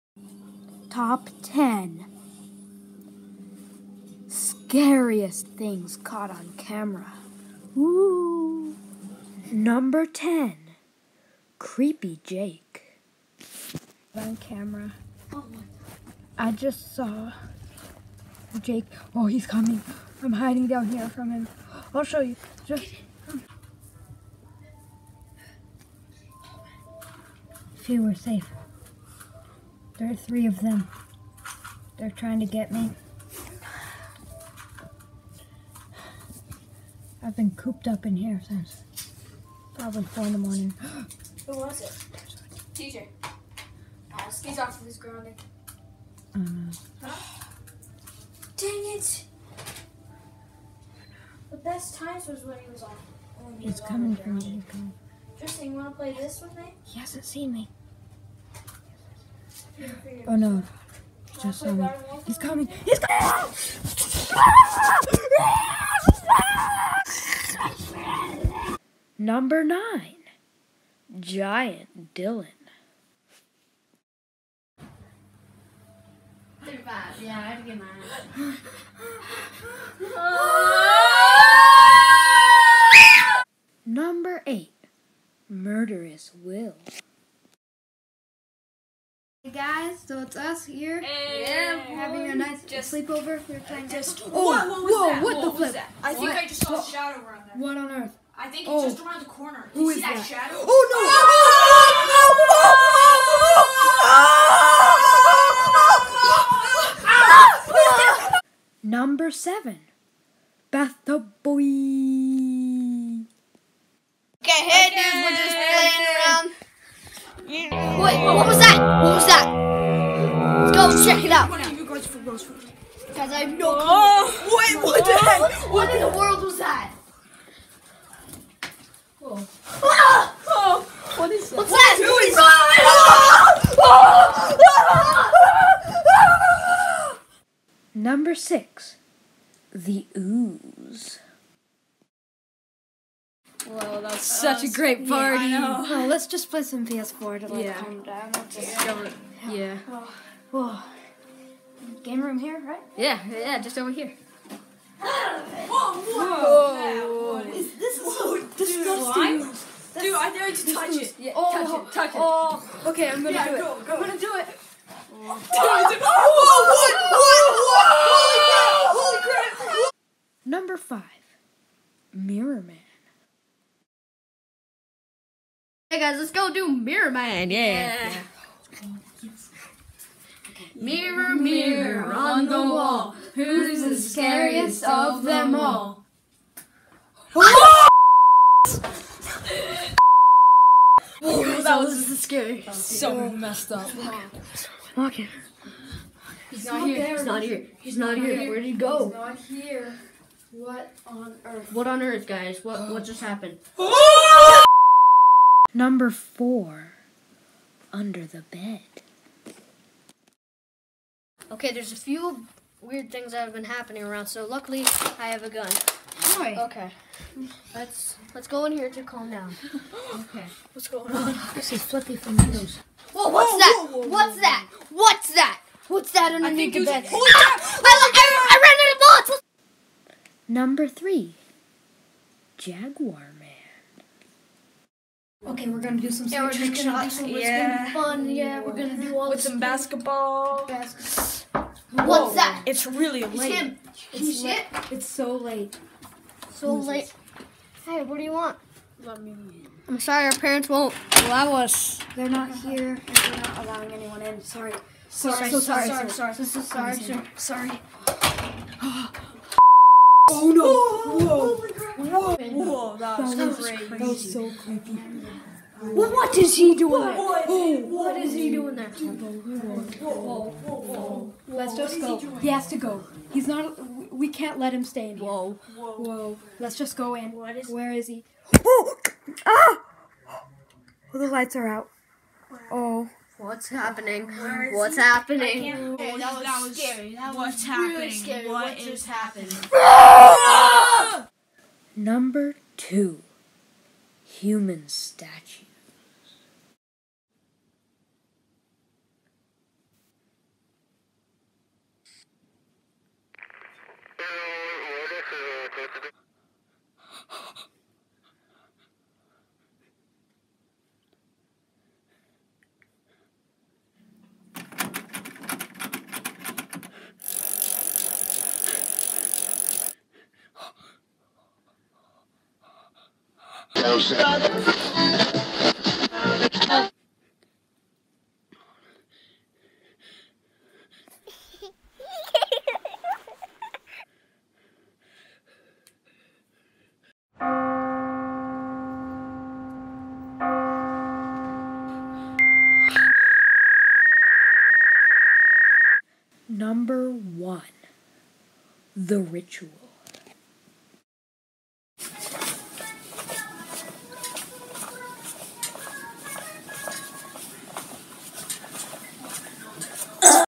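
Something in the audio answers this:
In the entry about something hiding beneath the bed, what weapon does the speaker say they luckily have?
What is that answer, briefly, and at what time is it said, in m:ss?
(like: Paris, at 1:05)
A gun, at 3:35.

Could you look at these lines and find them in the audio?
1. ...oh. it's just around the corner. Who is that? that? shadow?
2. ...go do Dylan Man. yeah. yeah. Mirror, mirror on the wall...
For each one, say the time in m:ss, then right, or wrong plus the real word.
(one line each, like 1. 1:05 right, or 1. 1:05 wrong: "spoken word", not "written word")
1. 1:38 right
2. 2:56 wrong: "Mirror", not "Dylan".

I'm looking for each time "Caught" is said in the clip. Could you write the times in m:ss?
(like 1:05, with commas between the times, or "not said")
0:05.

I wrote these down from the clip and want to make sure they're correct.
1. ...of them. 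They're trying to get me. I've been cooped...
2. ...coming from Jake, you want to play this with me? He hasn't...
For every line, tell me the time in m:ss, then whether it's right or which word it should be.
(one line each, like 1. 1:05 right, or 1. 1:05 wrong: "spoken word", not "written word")
1. 0:30 right
2. 0:53 wrong: "Tristan", not "Jake".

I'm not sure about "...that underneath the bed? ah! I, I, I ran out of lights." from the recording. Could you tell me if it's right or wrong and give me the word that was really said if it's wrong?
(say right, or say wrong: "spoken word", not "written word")
wrong: "bullets", not "lights".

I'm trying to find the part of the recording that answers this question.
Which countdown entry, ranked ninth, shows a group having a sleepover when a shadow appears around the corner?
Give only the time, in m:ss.
1:11.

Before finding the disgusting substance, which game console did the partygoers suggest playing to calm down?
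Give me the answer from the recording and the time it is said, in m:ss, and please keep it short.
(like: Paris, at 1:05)
PS4, at 2:26.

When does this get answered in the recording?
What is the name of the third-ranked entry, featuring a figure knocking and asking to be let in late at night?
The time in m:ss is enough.
3:52.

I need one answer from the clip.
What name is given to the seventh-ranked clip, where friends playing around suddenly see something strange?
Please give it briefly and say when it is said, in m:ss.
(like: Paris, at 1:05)
Bathtub boy, at 1:50.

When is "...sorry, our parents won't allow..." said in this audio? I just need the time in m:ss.
4:09.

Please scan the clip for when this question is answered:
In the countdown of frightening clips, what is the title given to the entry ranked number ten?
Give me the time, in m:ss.
0:11.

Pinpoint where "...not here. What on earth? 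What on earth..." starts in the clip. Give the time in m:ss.
3:19.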